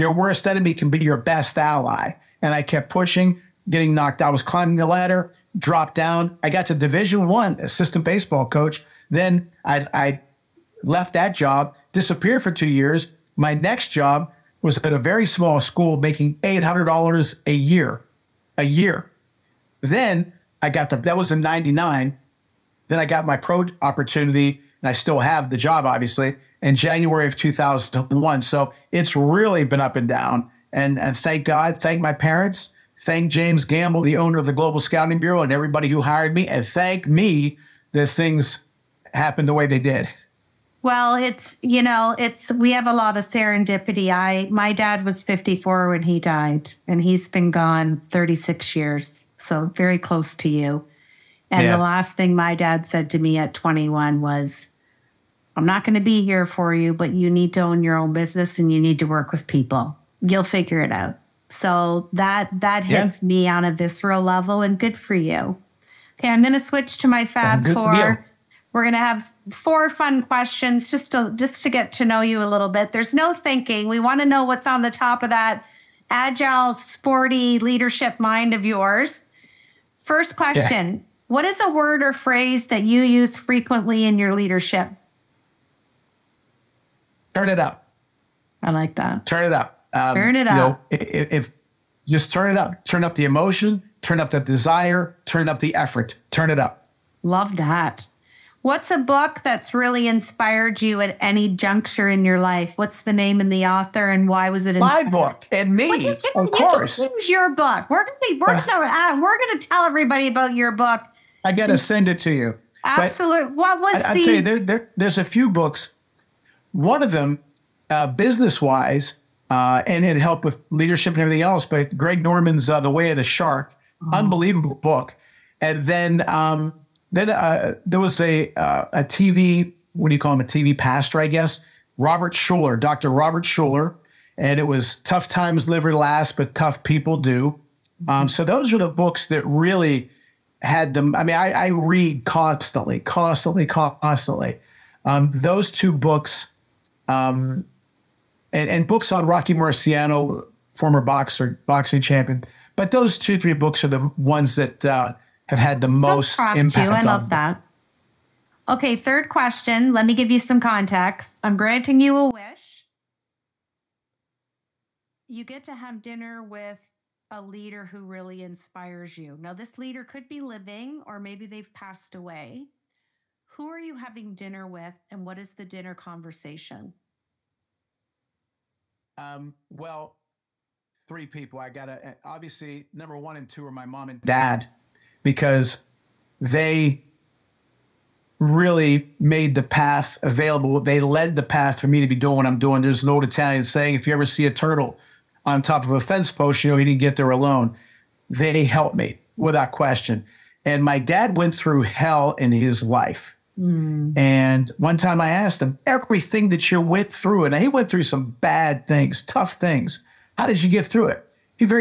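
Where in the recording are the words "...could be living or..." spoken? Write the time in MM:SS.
02:50.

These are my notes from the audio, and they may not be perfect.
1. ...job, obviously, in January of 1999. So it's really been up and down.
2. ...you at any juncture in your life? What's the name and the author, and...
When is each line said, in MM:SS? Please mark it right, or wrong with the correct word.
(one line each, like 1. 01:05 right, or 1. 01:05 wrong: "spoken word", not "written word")
1. 00:25 wrong: "2001", not "1999"
2. 01:40 right.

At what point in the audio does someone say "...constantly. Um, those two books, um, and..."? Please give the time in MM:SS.
02:23.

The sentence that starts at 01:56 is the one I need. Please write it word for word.
One of them, uh, business wise, uh, and it helped with leadership and everything else.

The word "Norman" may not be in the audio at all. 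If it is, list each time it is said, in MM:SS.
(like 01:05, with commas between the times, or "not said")
02:02.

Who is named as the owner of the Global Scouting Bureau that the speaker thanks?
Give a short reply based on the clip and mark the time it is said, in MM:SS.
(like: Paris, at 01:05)
James Gamble, at 00:33.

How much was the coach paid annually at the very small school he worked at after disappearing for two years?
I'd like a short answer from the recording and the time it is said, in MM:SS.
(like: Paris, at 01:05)
$800, at 00:16.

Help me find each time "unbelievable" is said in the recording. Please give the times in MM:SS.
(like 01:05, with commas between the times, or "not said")
02:04.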